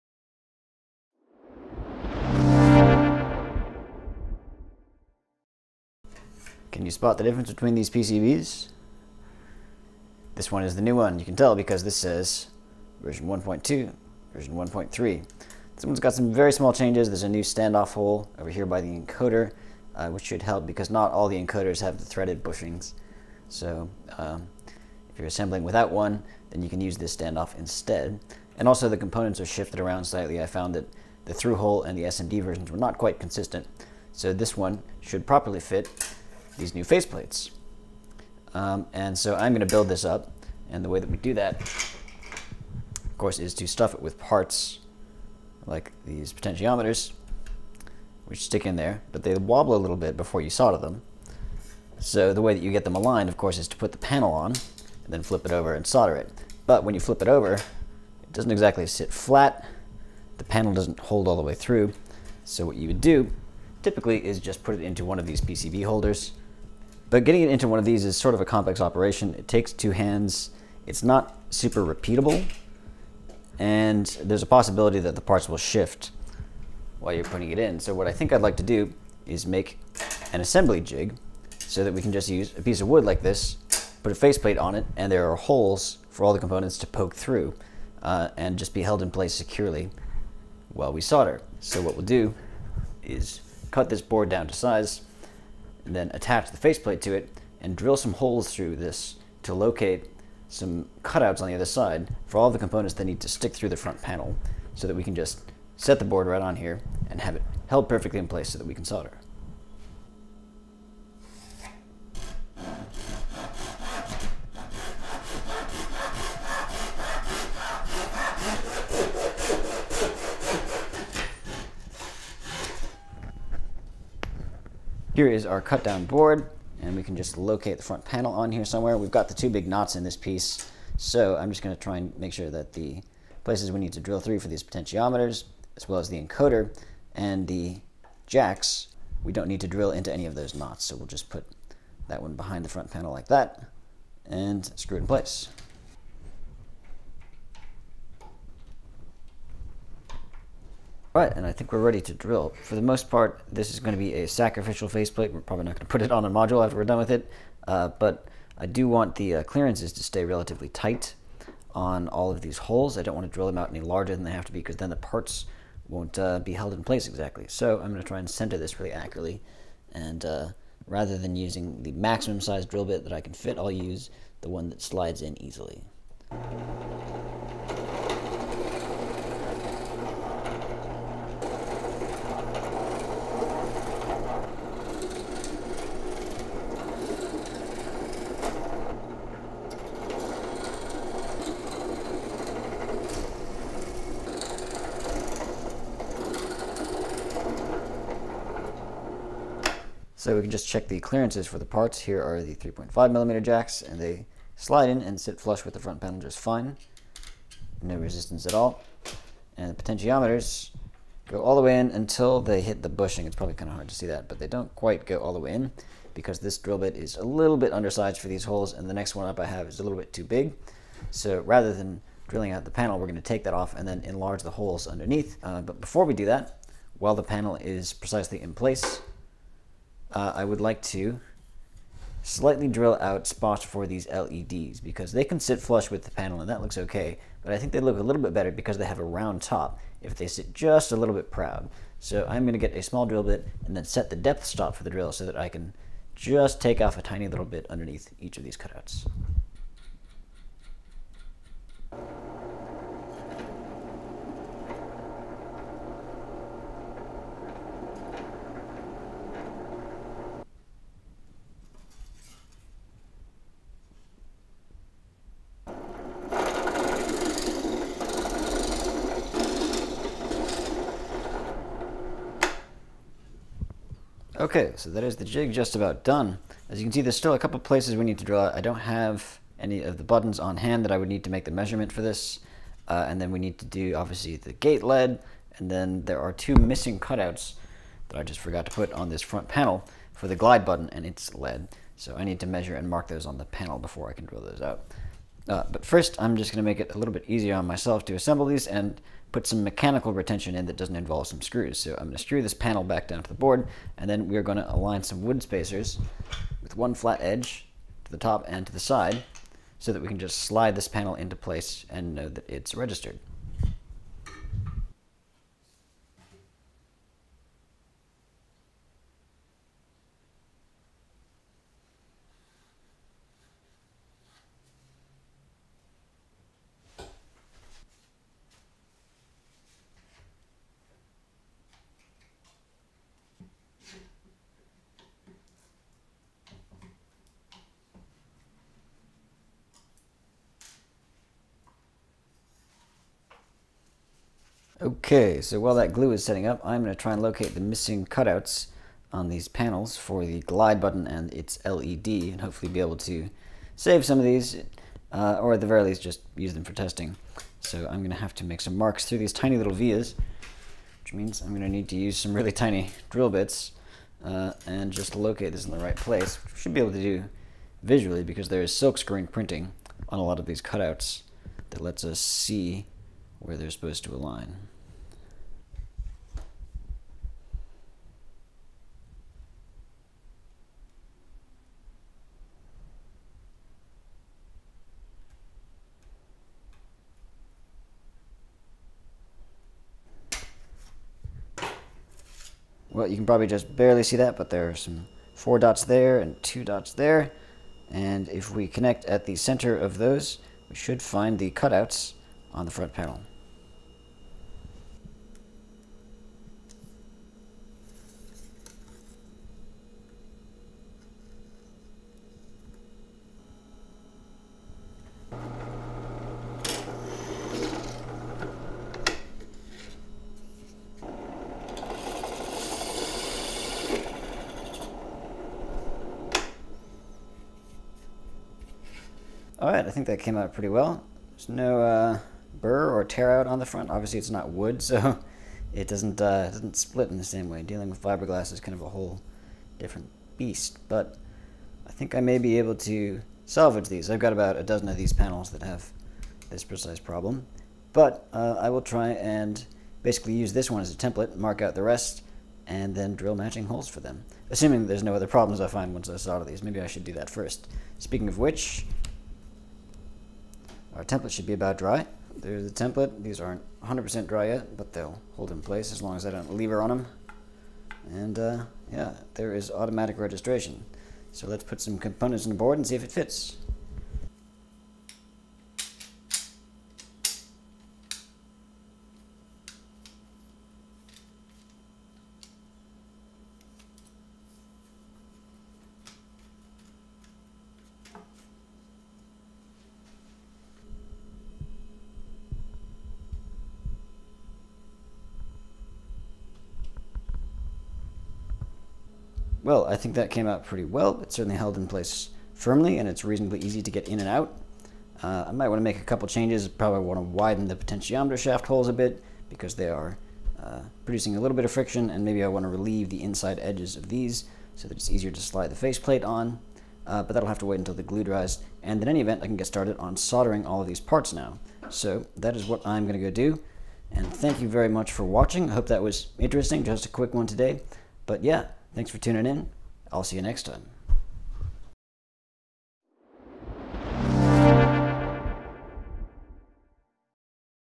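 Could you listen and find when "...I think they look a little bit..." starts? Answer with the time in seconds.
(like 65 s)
237 s.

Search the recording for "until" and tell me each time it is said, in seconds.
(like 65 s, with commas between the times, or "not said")
211 s, 517 s.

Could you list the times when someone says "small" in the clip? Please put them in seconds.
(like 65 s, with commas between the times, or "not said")
16 s, 242 s.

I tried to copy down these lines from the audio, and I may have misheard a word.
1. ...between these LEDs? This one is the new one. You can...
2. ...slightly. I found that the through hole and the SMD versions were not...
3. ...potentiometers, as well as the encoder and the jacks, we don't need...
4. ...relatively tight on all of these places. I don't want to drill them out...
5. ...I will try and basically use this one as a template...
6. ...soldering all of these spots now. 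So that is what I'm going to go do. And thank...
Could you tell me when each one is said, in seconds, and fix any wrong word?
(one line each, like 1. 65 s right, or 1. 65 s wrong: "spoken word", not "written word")
1. 7 s wrong: "PCBs", not "LEDs"
2. 30 s right
3. 134 s right
4. 160 s wrong: "holes", not "places"
5. 448 s right
6. 520 s wrong: "parts", not "spots".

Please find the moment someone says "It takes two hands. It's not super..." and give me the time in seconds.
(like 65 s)
69 s.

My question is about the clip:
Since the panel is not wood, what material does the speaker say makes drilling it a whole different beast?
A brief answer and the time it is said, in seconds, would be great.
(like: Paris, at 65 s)
fiberglass, at 438 s.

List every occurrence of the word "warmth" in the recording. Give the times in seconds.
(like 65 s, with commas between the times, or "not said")
not said.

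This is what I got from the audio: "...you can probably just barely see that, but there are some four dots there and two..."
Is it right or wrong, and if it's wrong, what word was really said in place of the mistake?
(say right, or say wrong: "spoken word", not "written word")
right.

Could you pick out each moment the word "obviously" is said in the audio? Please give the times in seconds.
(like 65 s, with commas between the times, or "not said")
283 s, 433 s.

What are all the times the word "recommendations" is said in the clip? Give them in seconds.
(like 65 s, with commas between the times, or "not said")
not said.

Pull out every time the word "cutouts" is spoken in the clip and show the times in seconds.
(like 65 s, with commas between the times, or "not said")
101 s, 248 s, 286 s, 348 s, 370 s, 401 s.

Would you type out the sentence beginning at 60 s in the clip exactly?
The panel doesn't hold all the way through.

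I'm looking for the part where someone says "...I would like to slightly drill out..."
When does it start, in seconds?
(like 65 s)
230 s.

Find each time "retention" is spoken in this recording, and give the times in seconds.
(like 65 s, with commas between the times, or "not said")
300 s.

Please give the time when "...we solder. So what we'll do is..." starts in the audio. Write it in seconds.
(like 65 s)
90 s.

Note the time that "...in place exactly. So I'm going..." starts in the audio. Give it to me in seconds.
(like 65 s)
166 s.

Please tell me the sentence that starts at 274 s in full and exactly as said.
Okay, so that is the jig just about done.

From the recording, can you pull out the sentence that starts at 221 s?
So rather than drilling out the panel, we're going to take that off and then enlarge the holes underneath.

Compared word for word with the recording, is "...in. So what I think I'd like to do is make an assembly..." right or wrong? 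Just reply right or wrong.
right.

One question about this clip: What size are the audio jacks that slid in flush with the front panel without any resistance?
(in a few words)
3.5 millimeter.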